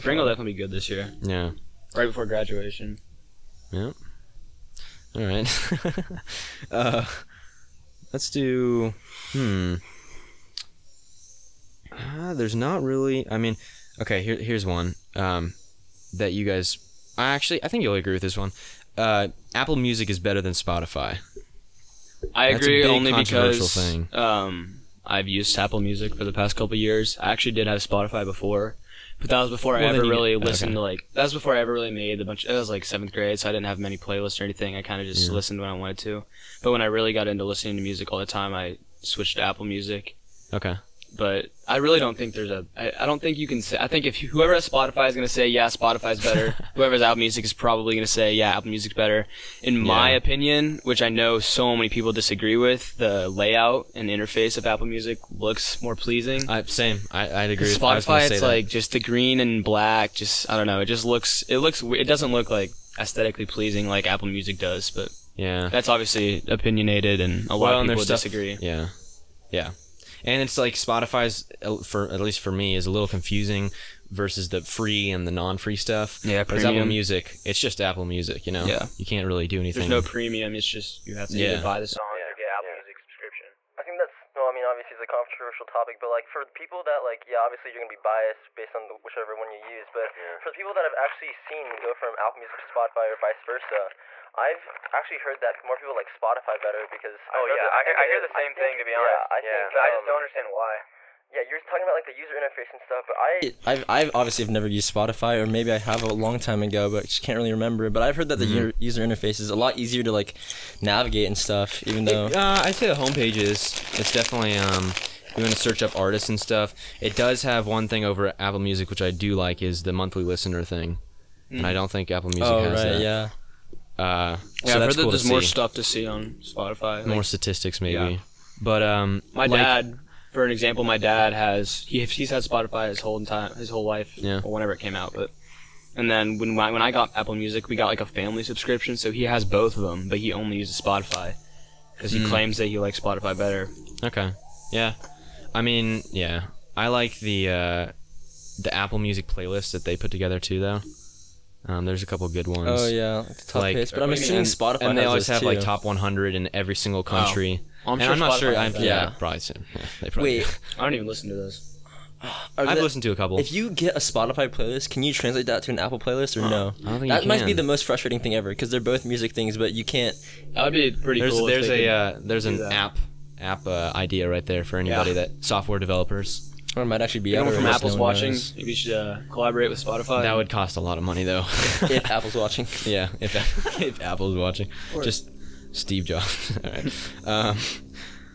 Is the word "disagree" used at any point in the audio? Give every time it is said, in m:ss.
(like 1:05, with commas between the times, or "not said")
0:52, 1:08.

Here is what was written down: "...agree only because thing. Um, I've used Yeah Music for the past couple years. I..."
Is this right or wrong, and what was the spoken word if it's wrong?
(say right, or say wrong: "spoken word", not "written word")
wrong: "Apple", not "Yeah".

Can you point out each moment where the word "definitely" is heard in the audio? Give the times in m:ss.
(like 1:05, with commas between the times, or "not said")
0:00, 1:54.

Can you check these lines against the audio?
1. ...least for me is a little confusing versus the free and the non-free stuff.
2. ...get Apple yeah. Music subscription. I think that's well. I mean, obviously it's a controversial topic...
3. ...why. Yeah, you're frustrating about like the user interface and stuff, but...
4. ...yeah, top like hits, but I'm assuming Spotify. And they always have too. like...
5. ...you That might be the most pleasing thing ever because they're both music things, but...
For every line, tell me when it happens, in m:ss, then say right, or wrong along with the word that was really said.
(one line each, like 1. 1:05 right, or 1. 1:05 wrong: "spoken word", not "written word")
1. 1:12 right
2. 1:22 right
3. 1:40 wrong: "talking", not "frustrating"
4. 2:32 right
5. 2:47 wrong: "frustrating", not "pleasing".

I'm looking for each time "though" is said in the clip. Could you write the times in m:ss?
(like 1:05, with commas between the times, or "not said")
1:52, 2:30, 3:01.